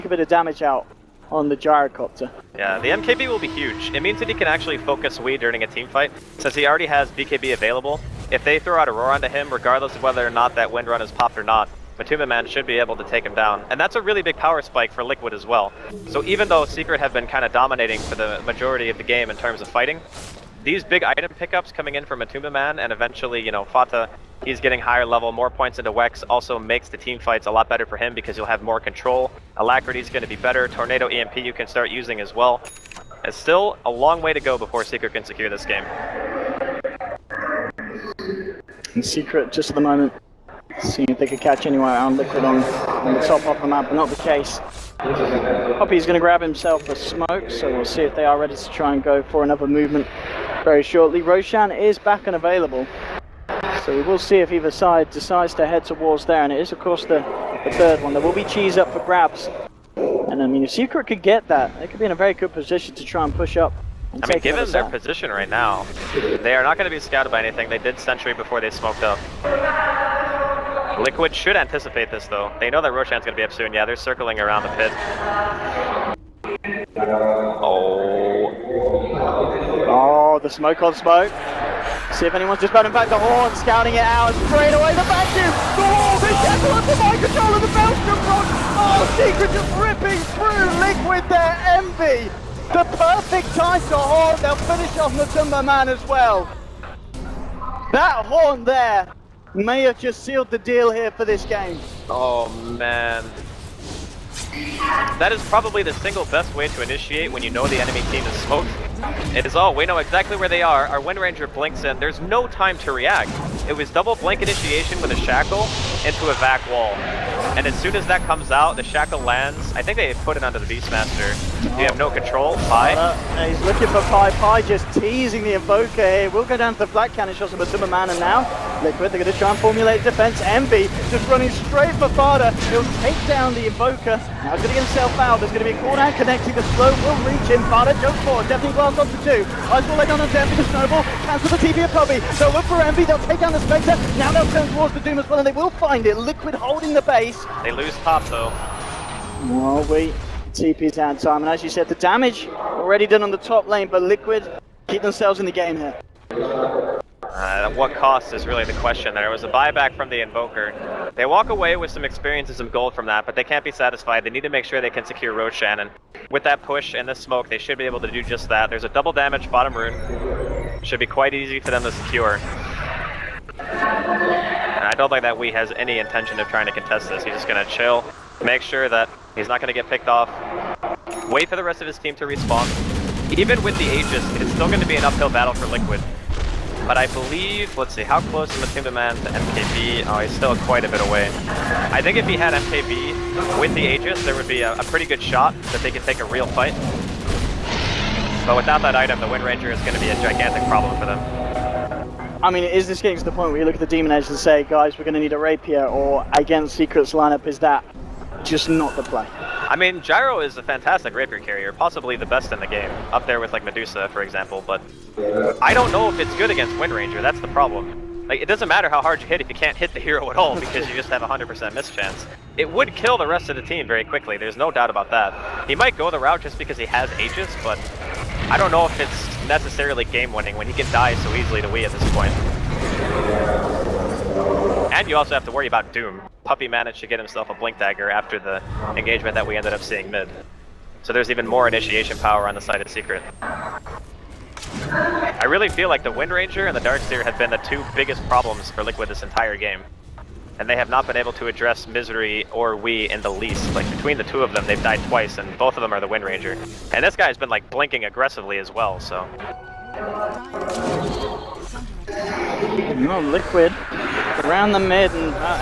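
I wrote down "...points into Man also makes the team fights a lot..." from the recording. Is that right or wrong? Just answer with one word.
wrong.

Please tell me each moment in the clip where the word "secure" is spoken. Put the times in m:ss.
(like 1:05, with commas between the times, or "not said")
0:35, 2:45, 2:51.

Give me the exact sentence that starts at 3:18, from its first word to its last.
But without that item, the Wind Ranger is going to be a gigantic problem for them.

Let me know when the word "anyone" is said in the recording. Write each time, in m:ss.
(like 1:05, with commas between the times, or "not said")
0:41, 1:22.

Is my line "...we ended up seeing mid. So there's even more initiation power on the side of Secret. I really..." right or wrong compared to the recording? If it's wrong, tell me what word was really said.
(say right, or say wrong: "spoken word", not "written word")
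right.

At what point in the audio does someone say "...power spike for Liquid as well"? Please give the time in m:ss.
0:14.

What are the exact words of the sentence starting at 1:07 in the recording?
They did Sentry before they smoked up.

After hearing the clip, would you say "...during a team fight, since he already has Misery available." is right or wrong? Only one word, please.
wrong.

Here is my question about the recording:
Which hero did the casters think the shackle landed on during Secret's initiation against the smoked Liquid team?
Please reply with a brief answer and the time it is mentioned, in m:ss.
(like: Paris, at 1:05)
Beastmaster, at 2:00.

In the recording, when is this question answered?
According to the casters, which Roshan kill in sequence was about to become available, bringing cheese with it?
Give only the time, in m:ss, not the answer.
0:57.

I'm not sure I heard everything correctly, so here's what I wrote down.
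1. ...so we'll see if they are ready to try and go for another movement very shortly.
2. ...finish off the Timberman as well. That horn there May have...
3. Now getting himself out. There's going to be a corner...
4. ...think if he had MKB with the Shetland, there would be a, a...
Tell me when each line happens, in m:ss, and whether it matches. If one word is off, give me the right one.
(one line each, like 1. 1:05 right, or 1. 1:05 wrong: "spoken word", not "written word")
1. 0:47 right
2. 1:34 right
3. 2:14 right
4. 3:12 wrong: "Aegis", not "Shetland".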